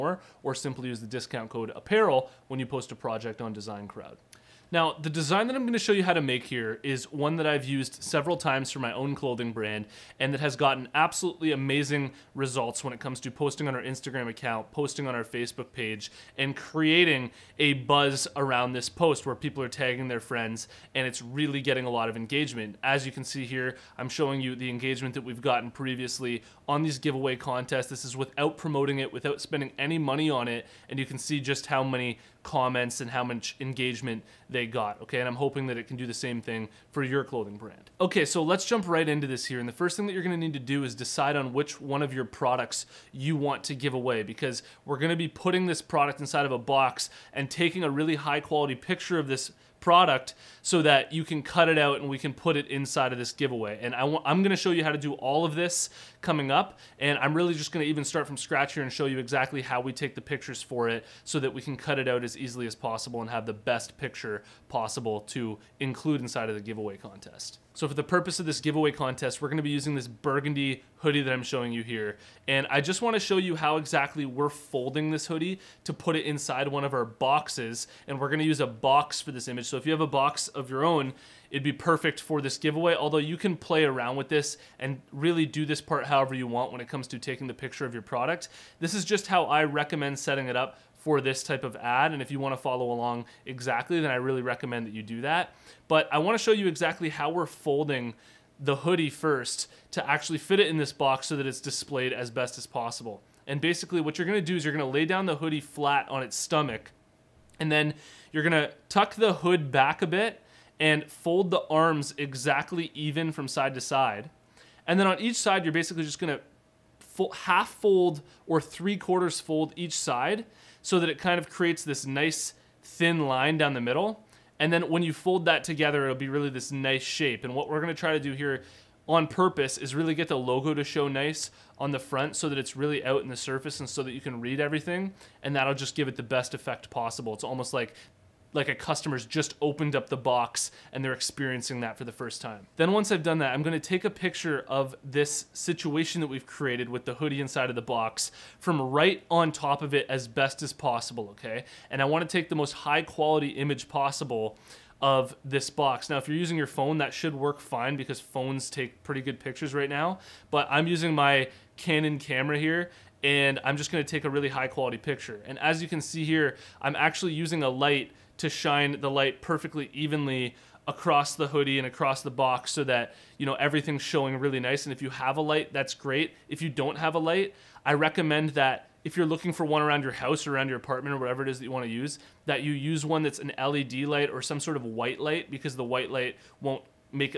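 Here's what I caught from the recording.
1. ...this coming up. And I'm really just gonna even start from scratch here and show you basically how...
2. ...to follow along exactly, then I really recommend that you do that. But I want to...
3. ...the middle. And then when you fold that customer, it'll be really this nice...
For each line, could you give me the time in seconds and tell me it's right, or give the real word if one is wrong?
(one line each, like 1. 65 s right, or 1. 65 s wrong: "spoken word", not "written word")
1. 55 s wrong: "exactly", not "basically"
2. 92 s right
3. 123 s wrong: "together", not "customer".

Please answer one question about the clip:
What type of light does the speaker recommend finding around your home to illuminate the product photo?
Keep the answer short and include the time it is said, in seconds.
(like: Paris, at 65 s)
LED light, at 183 s.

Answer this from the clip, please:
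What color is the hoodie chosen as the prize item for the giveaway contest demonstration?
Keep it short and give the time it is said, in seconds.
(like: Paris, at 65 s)
burgundy, at 70 s.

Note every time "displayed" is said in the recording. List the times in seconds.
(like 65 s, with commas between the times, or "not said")
101 s.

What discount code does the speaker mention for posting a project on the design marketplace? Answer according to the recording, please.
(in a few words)
apparel.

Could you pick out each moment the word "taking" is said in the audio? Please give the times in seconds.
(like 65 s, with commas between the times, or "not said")
47 s, 87 s.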